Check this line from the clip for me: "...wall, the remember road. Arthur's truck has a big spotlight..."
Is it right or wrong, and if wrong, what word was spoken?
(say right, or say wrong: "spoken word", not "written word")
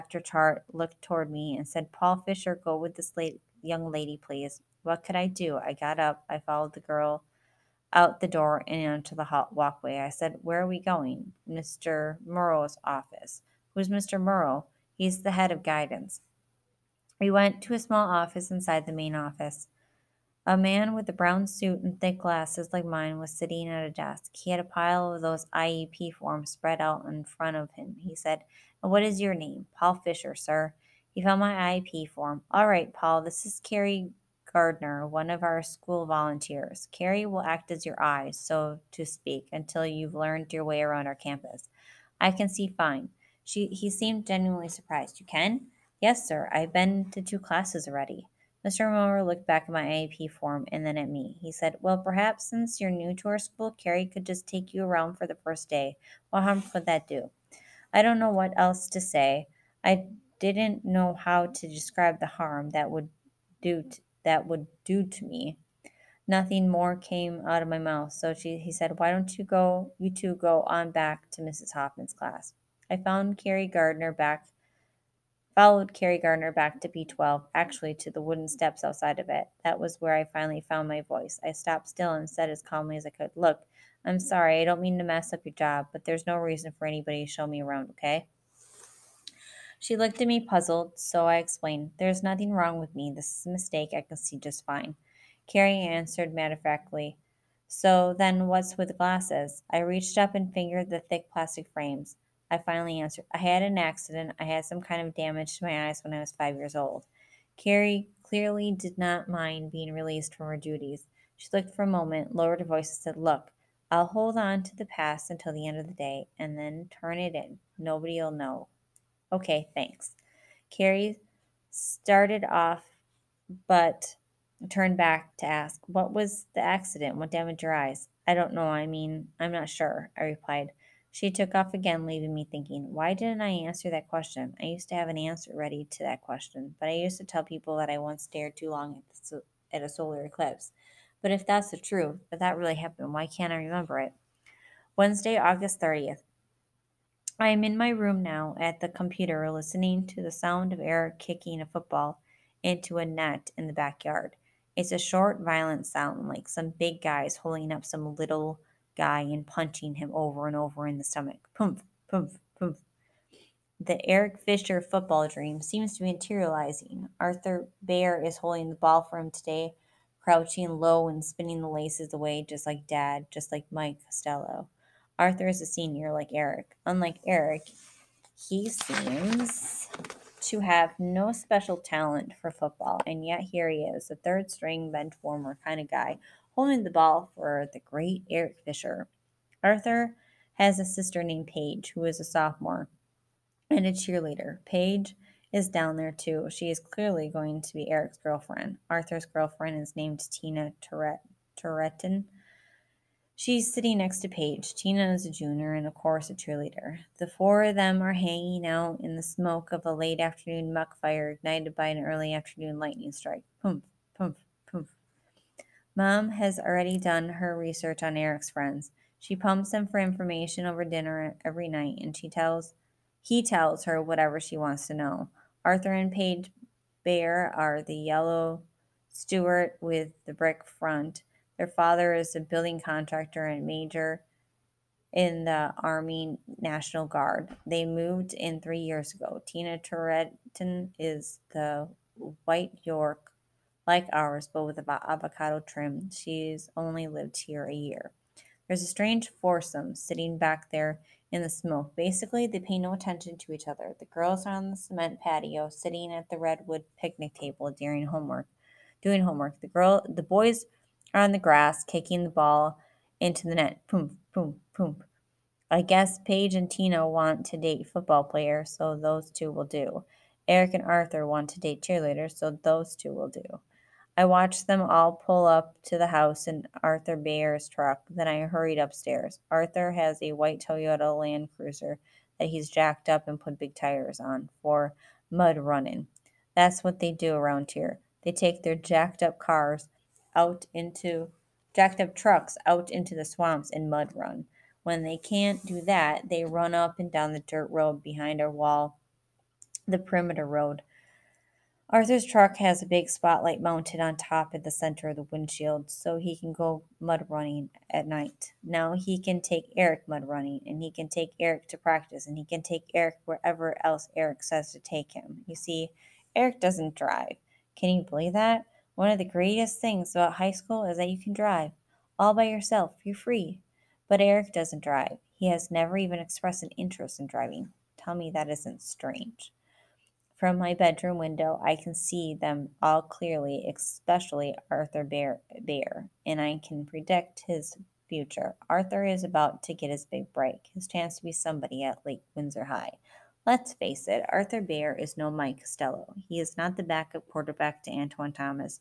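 wrong: "perimeter", not "remember".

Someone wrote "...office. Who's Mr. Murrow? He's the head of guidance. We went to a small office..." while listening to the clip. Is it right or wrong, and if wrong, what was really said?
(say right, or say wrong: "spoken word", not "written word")
right.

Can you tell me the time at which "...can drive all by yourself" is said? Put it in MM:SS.
05:21.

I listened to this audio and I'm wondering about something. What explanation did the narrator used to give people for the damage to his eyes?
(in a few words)
a solar eclipse.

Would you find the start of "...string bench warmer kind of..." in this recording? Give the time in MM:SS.
03:04.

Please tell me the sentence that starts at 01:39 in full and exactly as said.
I reached up and fingered the thick plastic frames.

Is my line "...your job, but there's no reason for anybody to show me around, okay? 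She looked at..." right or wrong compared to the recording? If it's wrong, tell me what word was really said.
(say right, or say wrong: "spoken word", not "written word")
right.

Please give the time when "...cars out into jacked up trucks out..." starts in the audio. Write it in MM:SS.
04:49.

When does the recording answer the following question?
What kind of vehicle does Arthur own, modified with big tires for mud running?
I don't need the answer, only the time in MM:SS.
04:40.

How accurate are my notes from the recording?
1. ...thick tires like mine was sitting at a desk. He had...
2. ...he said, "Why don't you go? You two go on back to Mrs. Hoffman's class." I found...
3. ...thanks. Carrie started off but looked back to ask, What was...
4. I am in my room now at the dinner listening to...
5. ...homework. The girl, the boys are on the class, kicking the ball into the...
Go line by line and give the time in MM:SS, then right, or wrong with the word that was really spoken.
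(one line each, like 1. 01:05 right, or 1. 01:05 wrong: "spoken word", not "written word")
1. 00:22 wrong: "glasses", not "tires"
2. 01:08 right
3. 01:59 wrong: "turned", not "looked"
4. 02:27 wrong: "computer", not "dinner"
5. 04:19 wrong: "grass", not "class".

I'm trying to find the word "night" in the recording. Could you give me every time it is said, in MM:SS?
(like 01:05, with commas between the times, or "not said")
03:41, 05:08.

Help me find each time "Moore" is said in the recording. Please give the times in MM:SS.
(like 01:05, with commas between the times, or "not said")
00:48.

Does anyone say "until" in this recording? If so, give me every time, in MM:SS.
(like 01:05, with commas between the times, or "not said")
00:39, 01:55.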